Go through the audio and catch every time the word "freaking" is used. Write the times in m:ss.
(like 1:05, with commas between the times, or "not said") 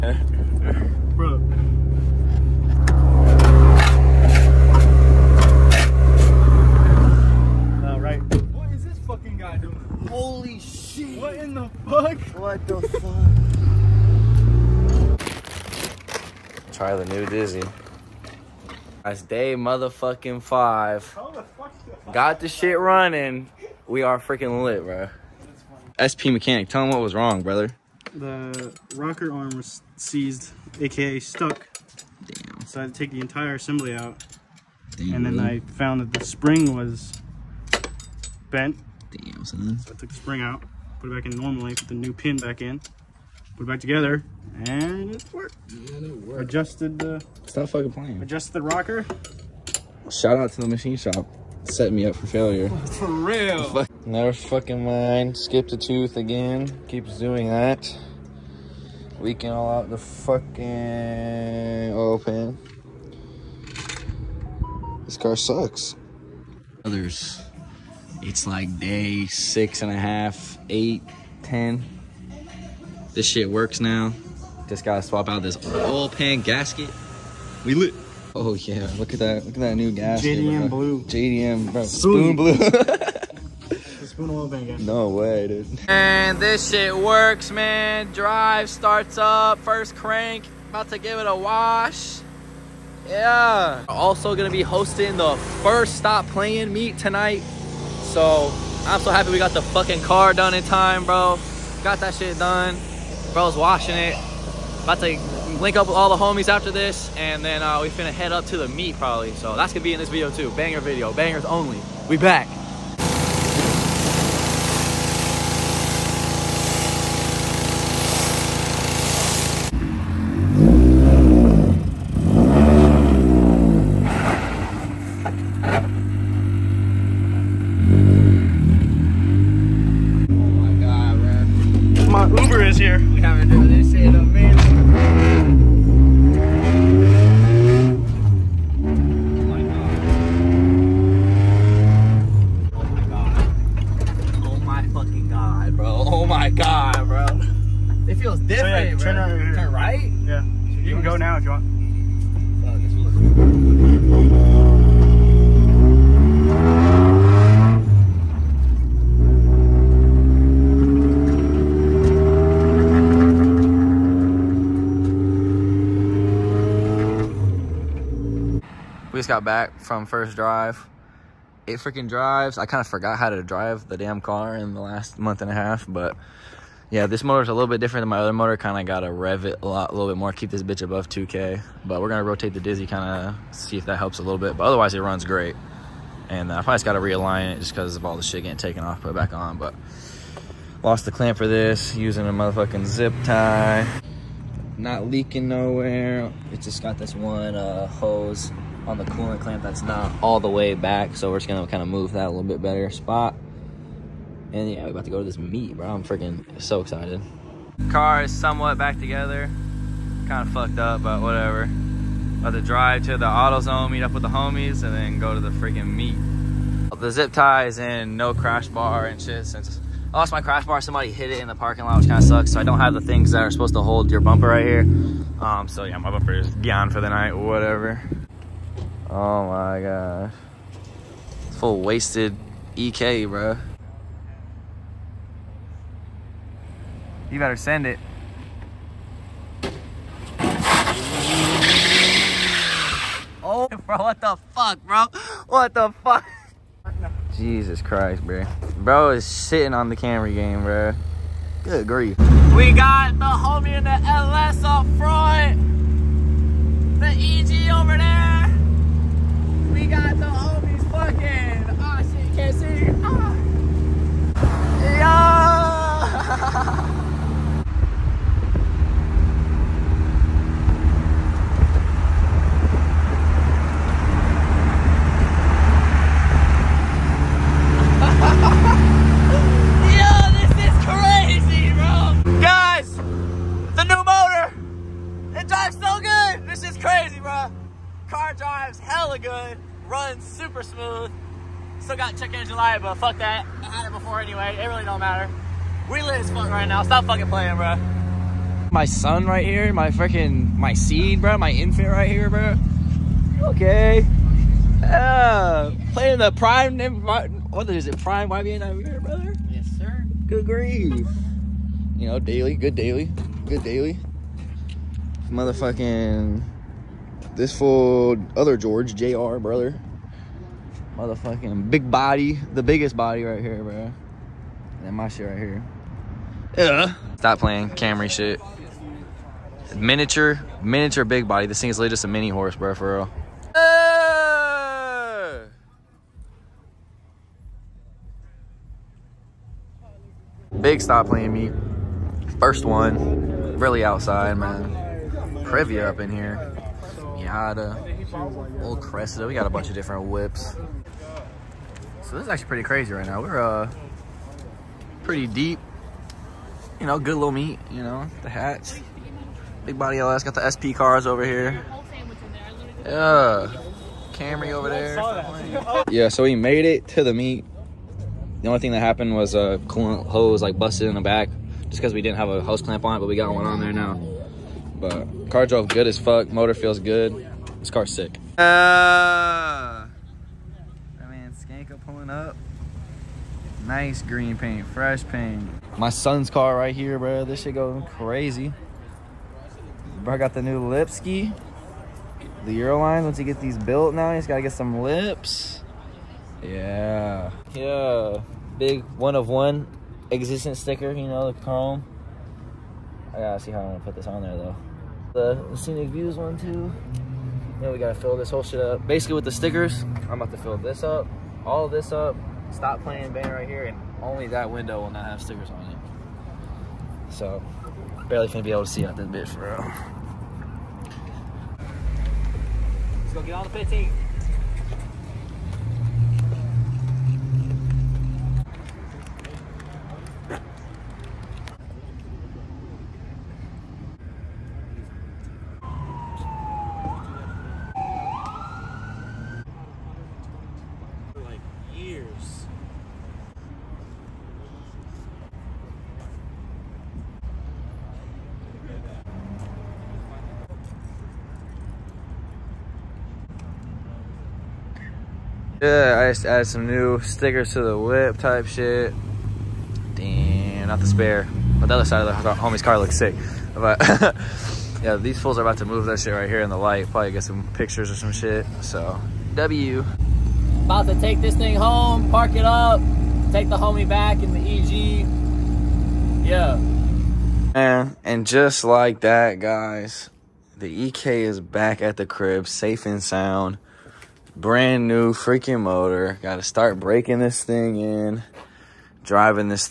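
0:24, 2:51, 3:26, 3:35, 4:59, 8:05.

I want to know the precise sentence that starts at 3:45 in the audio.
Um, so yeah, my bumper is gone for the night, whatever.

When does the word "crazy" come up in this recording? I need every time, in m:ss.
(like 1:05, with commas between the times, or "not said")
5:52, 6:27.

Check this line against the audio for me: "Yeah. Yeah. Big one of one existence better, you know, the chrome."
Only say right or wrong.
wrong.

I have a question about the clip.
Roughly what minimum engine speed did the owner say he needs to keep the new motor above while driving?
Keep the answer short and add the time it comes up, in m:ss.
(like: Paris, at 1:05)
2K, at 3:01.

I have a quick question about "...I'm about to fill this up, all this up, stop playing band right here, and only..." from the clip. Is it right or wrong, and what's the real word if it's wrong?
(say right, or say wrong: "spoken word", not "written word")
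right.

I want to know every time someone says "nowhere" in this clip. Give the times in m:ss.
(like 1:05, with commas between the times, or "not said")
3:15.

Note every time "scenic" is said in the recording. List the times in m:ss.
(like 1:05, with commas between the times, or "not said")
6:45.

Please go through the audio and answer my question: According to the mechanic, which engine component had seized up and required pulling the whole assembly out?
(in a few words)
The rocker arm.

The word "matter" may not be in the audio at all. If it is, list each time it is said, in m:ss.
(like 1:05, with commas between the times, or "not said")
4:55.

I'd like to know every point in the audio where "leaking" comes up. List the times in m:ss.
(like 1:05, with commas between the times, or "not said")
0:59, 3:15.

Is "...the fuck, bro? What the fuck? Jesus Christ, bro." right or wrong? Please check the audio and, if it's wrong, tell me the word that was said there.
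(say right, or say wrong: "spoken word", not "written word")
right.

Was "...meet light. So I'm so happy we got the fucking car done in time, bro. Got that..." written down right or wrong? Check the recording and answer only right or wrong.
wrong.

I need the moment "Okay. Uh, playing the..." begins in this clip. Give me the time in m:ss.
5:03.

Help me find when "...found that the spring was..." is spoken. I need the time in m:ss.
0:35.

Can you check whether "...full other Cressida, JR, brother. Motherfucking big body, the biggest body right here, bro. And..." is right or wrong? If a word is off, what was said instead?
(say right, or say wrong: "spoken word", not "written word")
wrong: "George", not "Cressida".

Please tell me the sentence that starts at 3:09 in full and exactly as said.
But lost the clamp for this, using a motherfucking zip tie.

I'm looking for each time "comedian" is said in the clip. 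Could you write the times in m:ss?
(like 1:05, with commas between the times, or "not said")
not said.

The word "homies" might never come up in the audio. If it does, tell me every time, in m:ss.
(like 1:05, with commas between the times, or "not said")
1:46, 3:34, 4:13, 4:20, 7:42, 7:53.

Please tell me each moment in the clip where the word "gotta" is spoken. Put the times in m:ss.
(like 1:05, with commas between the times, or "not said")
1:14, 6:34, 6:43, 6:47.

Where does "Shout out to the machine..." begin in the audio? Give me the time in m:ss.
0:50.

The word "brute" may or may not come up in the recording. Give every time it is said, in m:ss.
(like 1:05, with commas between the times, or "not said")
not said.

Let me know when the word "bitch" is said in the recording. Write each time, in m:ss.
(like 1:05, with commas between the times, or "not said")
3:00, 6:59.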